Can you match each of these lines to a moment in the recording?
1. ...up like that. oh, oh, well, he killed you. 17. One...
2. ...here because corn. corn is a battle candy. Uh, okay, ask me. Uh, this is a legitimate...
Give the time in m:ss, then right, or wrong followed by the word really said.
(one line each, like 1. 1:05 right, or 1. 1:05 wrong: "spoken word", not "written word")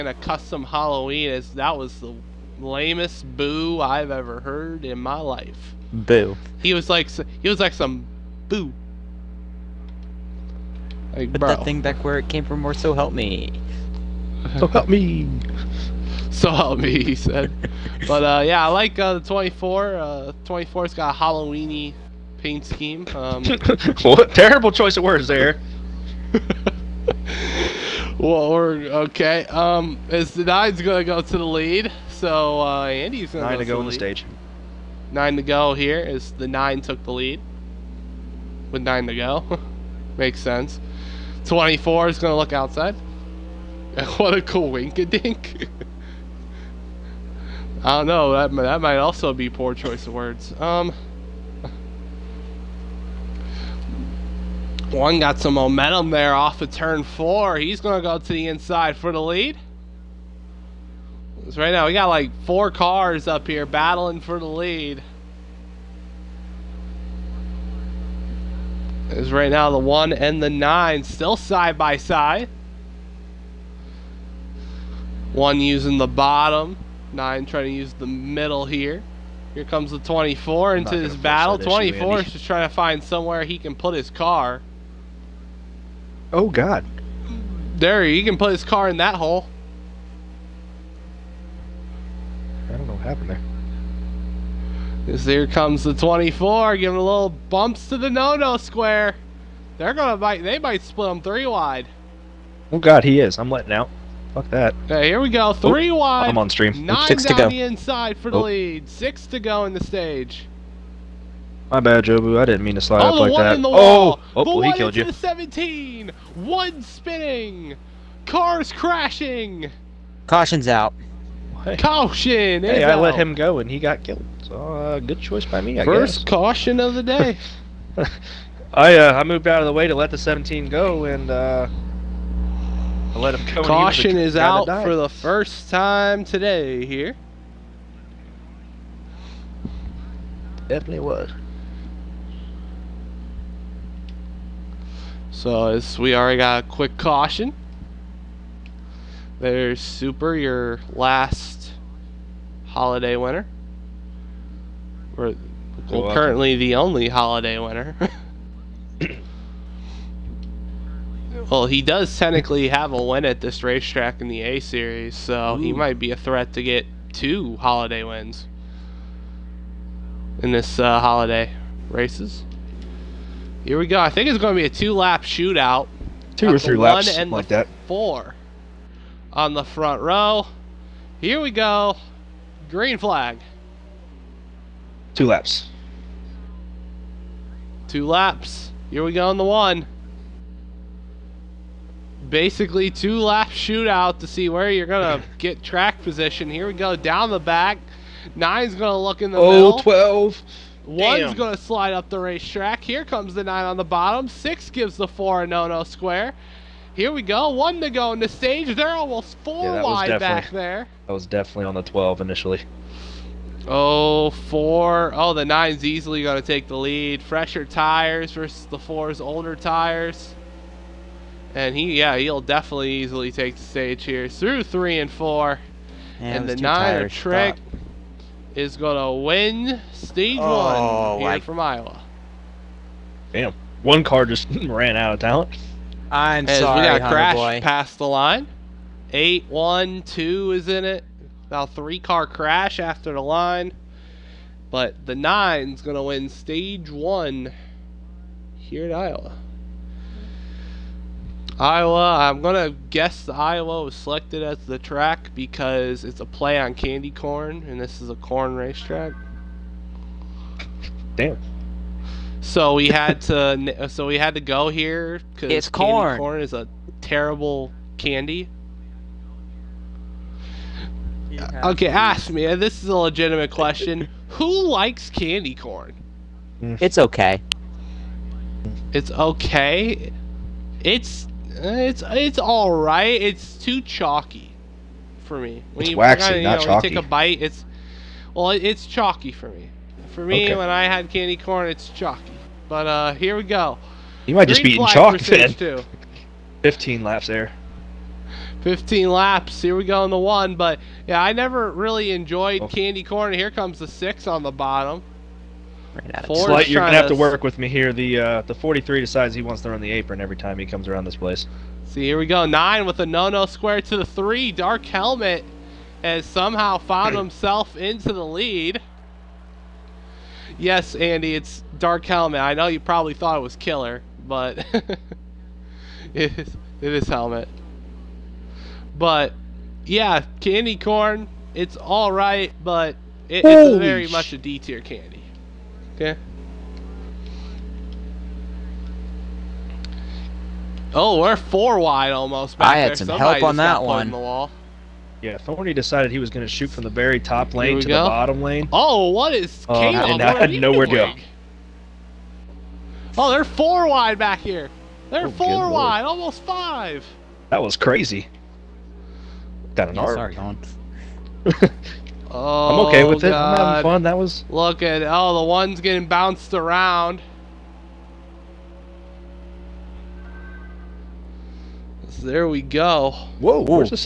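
1. 1:53 right
2. 4:24 wrong: "terrible", not "battle".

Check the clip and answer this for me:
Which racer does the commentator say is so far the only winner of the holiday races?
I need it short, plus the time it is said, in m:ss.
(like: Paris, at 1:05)
Super, at 2:29.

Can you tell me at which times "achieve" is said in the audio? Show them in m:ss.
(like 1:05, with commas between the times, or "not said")
not said.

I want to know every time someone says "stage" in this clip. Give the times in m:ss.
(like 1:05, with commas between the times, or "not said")
0:33, 1:49, 3:28, 3:43, 3:49, 4:06.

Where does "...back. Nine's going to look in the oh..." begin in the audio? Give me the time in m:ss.
3:17.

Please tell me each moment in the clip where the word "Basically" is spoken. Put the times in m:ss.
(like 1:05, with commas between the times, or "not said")
3:12.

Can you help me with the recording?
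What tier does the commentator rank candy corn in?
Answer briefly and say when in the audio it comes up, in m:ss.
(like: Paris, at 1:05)
D tier, at 5:33.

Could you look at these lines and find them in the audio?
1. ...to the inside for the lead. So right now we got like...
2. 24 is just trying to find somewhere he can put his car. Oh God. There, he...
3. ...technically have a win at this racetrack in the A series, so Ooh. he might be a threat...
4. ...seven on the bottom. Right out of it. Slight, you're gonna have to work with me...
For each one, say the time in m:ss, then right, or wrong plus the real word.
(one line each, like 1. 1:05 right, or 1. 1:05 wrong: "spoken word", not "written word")
1. 0:58 right
2. 1:21 right
3. 2:42 right
4. 5:03 wrong: "six", not "seven".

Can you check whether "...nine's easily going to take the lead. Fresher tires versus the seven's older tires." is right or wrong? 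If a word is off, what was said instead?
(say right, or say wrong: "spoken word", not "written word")
wrong: "four", not "seven".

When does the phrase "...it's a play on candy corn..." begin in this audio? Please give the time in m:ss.
4:16.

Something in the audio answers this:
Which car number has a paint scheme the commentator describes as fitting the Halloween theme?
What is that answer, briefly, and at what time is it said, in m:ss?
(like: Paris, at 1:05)
24, at 0:20.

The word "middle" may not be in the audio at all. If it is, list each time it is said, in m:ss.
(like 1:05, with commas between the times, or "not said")
1:18, 3:19.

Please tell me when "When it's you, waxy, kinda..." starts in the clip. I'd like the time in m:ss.
4:45.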